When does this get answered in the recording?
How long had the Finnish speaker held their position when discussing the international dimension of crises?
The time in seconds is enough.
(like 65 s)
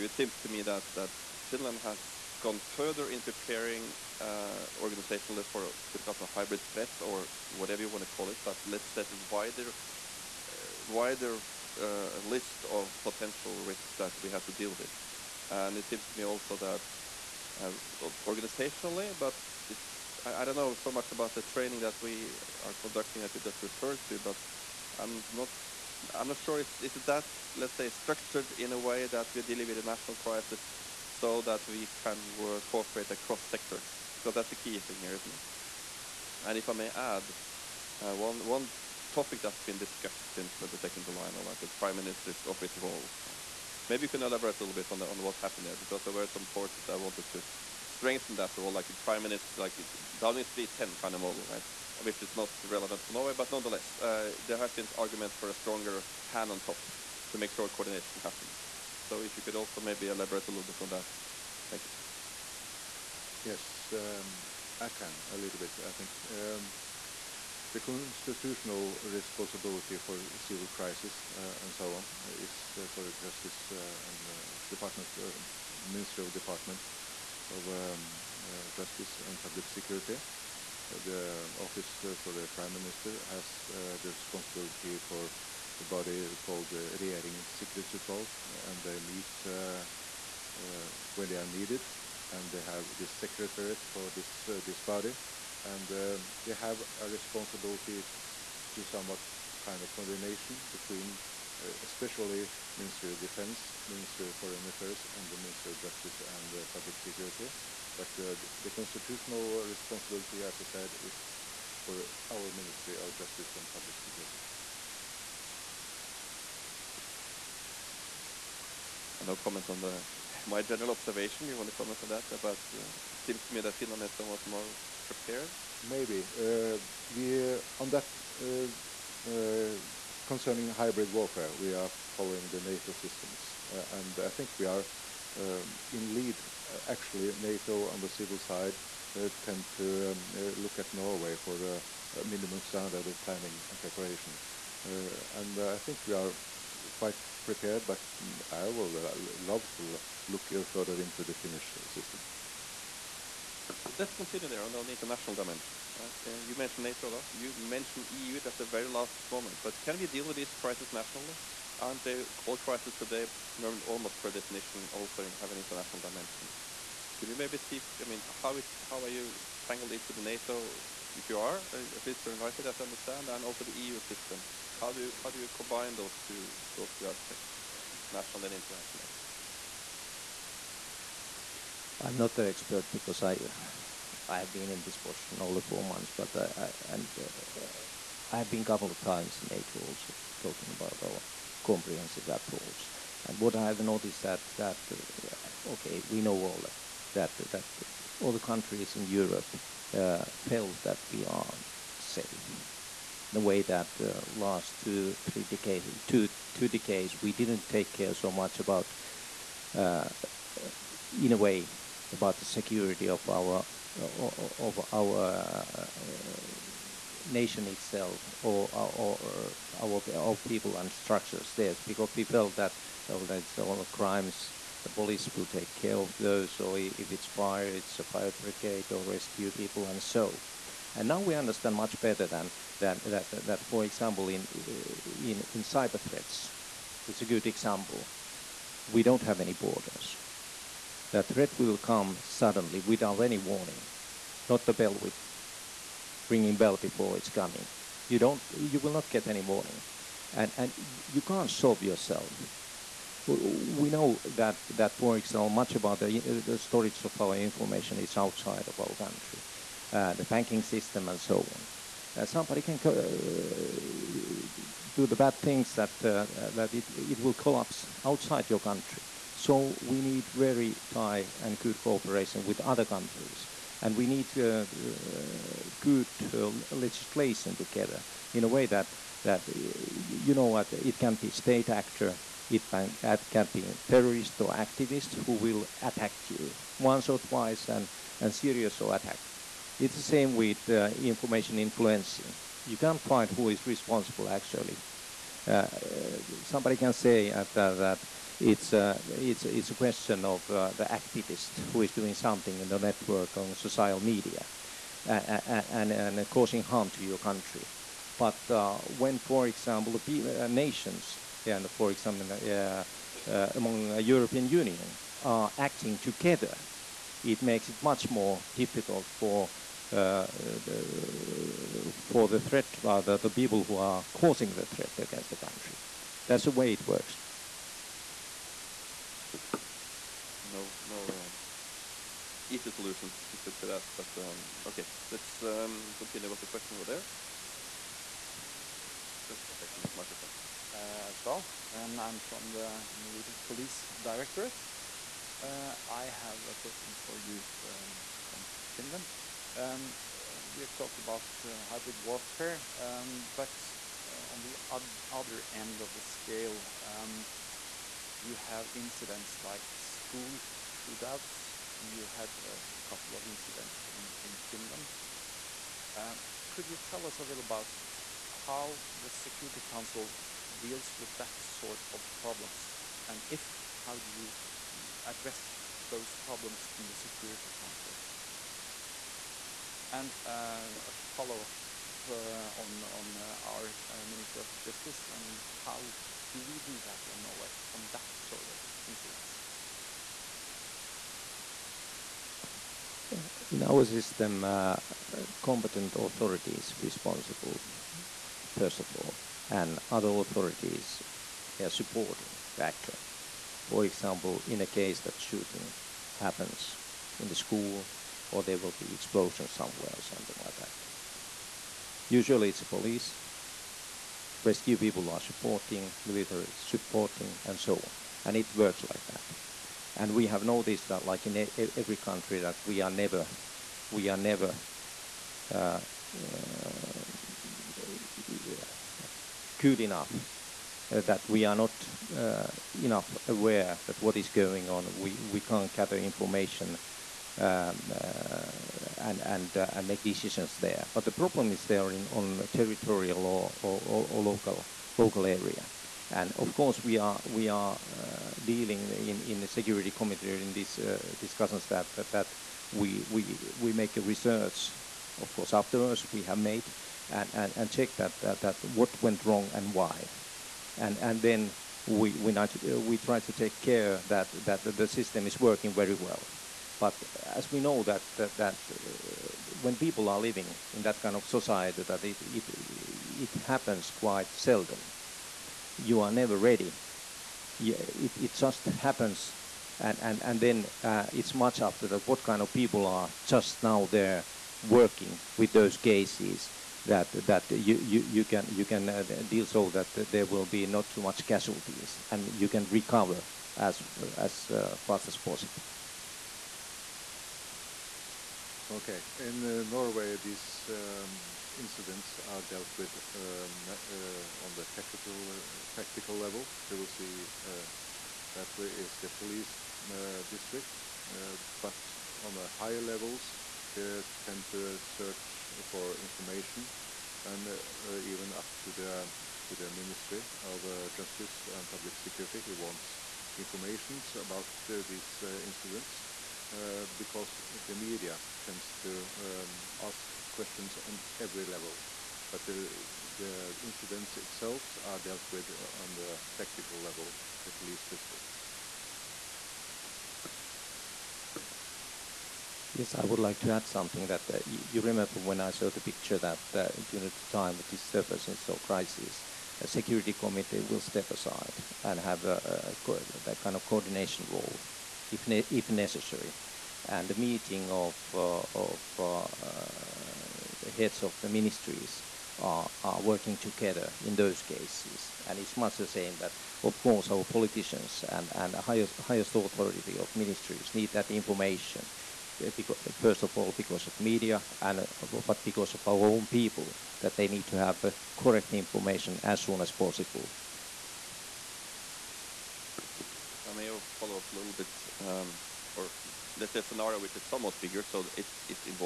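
185 s.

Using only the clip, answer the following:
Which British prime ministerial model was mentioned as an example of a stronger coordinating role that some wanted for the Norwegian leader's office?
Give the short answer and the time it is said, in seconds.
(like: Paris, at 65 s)
Downing Street 10, at 50 s.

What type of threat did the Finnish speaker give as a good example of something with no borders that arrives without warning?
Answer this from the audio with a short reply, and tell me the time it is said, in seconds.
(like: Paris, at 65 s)
Cyber threats, at 235 s.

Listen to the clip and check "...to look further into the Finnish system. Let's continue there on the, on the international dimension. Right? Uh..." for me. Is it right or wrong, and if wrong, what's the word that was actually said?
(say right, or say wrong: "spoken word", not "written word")
right.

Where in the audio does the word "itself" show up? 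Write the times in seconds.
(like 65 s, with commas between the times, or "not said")
217 s, 534 s.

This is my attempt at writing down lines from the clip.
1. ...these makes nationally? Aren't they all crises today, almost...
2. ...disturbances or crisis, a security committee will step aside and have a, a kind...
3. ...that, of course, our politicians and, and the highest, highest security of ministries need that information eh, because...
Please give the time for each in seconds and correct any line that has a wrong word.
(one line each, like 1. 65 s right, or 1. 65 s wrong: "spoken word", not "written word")
1. 160 s wrong: "crises", not "makes"
2. 547 s right
3. 566 s wrong: "authority", not "security".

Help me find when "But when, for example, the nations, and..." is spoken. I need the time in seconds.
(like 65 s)
308 s.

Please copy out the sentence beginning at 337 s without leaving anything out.
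Yes, my name is just second, microphone.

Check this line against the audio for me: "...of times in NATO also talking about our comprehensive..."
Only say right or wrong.
right.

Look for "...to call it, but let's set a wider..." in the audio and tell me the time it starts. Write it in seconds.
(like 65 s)
8 s.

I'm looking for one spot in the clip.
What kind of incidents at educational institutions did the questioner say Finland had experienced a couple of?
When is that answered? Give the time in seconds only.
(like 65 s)
359 s.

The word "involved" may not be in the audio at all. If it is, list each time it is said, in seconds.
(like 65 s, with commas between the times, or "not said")
not said.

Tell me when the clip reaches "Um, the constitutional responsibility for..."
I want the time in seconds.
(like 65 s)
66 s.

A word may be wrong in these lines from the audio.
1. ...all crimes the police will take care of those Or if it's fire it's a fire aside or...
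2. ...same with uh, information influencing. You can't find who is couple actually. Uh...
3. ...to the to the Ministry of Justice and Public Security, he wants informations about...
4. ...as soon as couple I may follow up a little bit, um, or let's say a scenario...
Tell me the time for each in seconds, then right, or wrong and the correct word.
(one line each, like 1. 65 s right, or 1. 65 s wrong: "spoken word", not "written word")
1. 223 s wrong: "brigade", not "aside"
2. 290 s wrong: "responsible", not "couple"
3. 518 s right
4. 579 s wrong: "possible", not "couple".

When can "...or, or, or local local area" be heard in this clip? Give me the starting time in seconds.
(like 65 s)
443 s.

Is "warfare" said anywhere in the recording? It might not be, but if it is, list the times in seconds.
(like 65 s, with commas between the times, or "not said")
131 s, 352 s.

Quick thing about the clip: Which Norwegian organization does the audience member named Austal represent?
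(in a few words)
Norwegian Police Directorate.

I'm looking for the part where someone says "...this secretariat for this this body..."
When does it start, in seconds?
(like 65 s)
92 s.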